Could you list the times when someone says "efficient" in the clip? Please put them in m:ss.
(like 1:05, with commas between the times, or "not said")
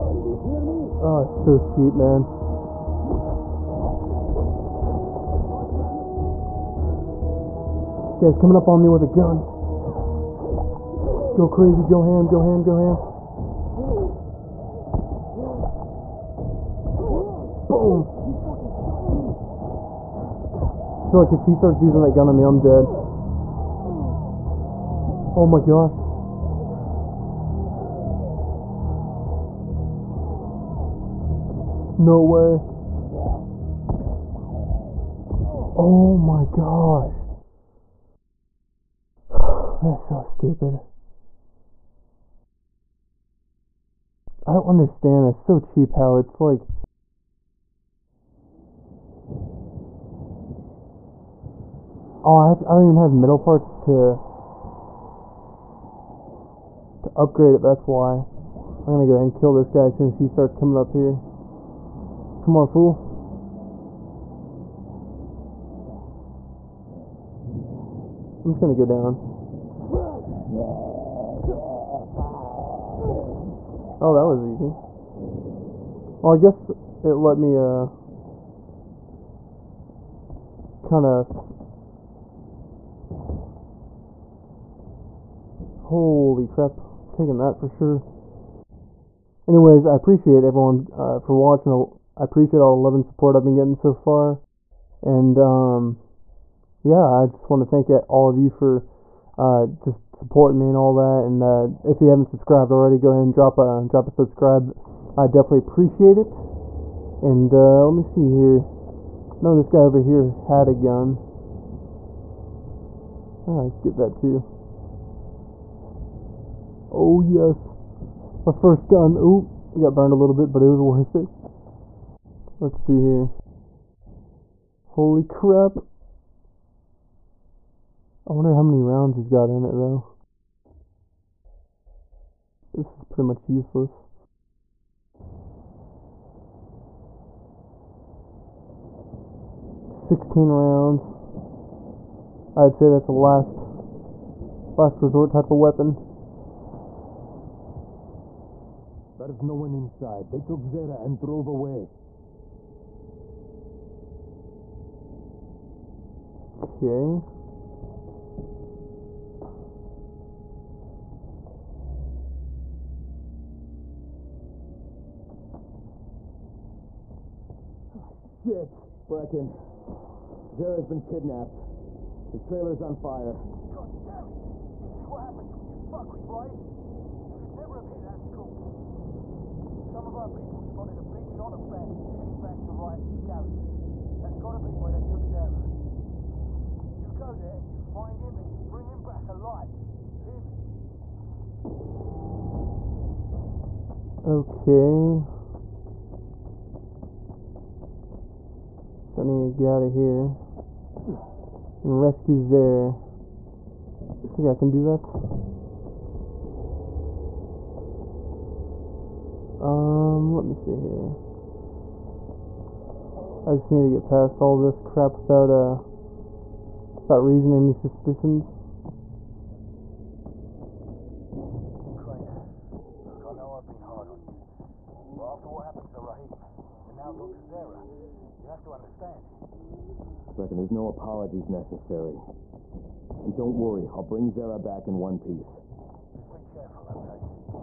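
not said.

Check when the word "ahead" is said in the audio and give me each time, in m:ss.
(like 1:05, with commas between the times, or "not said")
0:59, 1:43.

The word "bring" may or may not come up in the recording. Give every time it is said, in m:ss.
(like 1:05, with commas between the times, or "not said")
3:08, 3:54.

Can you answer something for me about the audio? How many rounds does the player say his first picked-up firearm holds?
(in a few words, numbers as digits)
16.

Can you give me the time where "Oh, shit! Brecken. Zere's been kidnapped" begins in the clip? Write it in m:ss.
2:47.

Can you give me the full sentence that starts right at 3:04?
That's gotta be where they took Zere.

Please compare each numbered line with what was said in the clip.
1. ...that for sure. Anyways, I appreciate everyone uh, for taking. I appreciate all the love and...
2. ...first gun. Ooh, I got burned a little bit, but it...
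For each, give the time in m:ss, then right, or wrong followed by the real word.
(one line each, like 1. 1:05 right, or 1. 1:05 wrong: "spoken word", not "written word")
1. 1:27 wrong: "watching", not "taking"
2. 1:58 right.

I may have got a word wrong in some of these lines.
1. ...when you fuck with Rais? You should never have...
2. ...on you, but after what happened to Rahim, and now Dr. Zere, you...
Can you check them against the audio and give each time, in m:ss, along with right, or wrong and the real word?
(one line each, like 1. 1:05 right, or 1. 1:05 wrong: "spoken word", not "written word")
1. 2:55 right
2. 3:44 right.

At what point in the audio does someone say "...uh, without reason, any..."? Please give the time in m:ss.
3:35.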